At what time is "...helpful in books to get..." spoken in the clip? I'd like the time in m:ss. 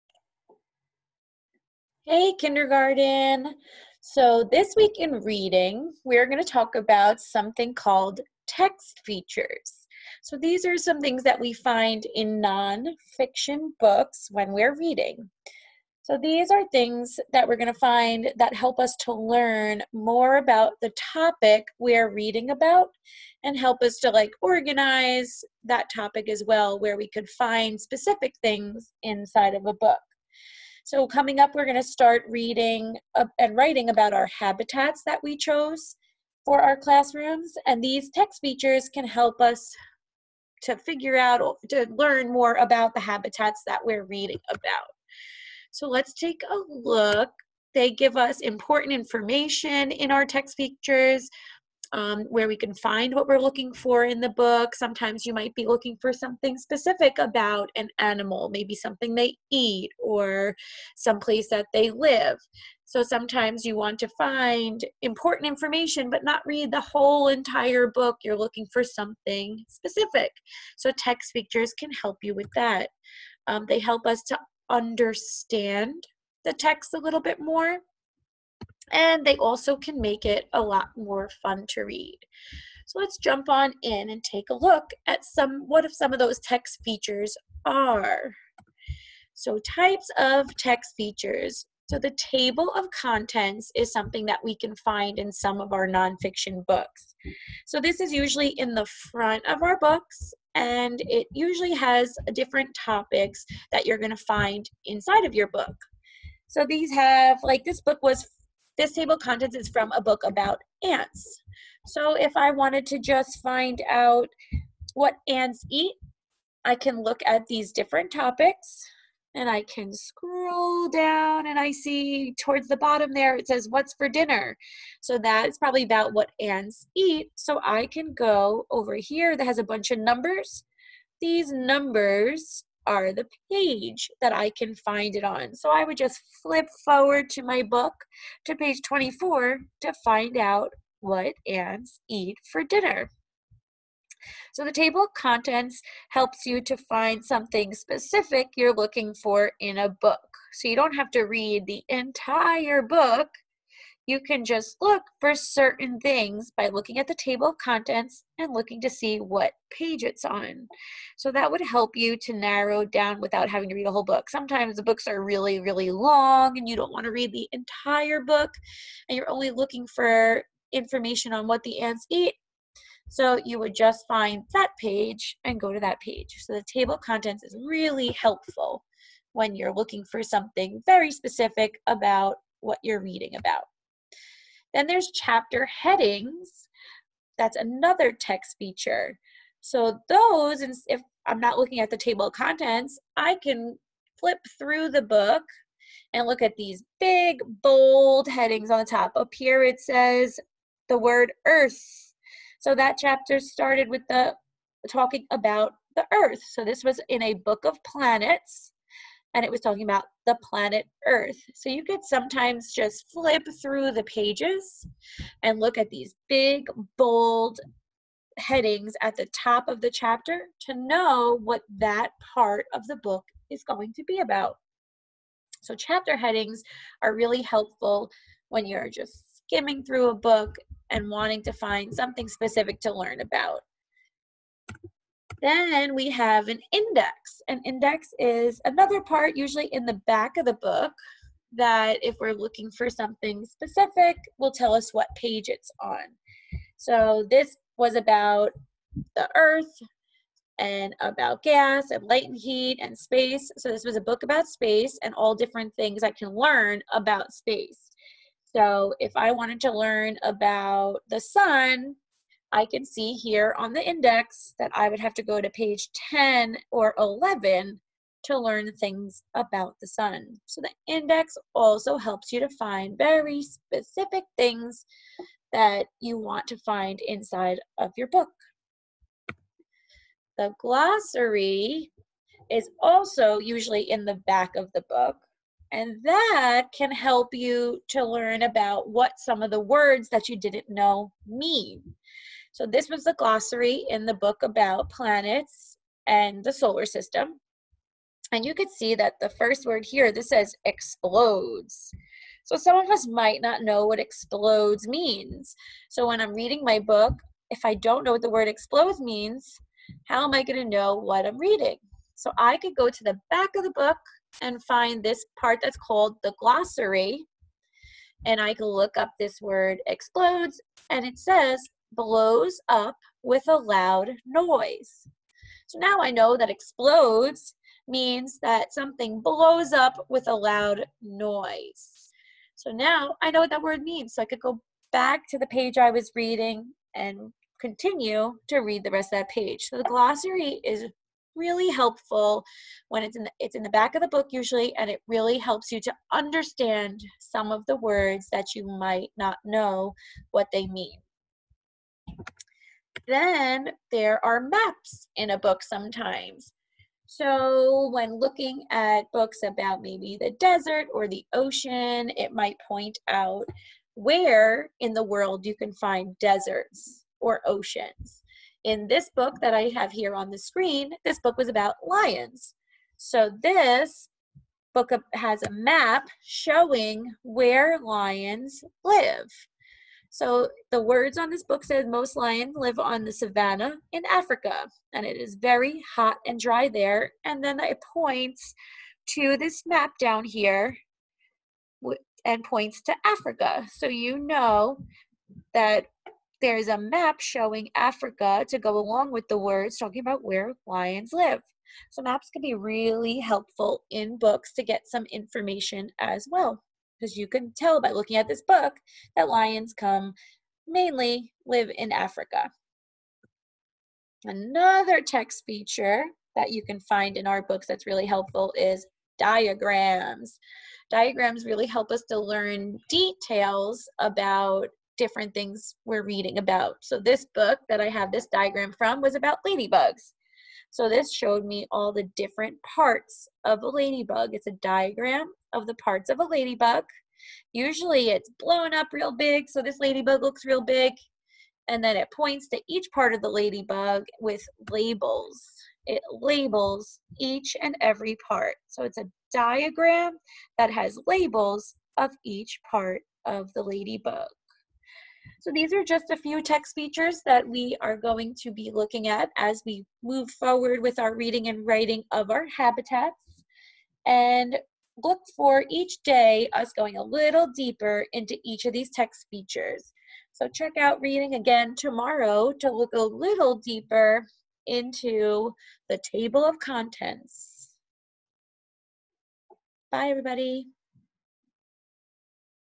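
6:43.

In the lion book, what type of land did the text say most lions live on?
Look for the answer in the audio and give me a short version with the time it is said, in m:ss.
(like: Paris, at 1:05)
Savannah, at 6:23.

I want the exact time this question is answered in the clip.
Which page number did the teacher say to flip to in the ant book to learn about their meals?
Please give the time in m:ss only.
2:18.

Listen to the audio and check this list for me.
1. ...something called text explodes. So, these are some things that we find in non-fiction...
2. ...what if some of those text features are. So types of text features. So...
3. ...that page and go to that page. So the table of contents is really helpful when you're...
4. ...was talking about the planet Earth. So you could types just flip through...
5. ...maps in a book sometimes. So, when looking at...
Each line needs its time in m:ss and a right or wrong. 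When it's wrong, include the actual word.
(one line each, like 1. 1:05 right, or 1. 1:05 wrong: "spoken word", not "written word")
1. 0:07 wrong: "features", not "explodes"
2. 1:25 right
3. 2:54 right
4. 3:29 wrong: "sometimes", not "types"
5. 5:54 right.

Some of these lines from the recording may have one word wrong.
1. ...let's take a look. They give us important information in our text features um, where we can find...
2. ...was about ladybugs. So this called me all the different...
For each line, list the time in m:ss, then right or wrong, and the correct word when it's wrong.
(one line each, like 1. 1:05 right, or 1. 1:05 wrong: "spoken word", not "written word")
1. 0:45 right
2. 7:09 wrong: "showed", not "called".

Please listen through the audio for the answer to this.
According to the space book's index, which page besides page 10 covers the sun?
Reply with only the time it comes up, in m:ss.
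4:26.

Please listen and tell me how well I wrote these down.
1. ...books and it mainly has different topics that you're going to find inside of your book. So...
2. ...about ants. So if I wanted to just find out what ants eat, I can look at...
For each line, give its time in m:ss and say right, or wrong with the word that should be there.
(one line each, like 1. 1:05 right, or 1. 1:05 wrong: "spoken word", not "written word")
1. 1:39 wrong: "usually", not "mainly"
2. 1:50 right.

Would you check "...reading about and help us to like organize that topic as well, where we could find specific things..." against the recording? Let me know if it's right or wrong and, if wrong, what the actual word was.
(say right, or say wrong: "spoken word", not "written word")
right.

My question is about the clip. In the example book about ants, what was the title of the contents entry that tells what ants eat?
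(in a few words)
What's for dinner.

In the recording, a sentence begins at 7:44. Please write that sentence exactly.
And look for each day us going a little deeper into each of these text features.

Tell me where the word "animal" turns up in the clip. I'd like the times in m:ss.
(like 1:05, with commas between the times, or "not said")
0:57.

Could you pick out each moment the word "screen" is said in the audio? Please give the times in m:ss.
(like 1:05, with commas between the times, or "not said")
6:10.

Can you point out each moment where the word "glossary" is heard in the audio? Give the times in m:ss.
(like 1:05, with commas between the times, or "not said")
4:40, 4:53, 5:16, 5:39.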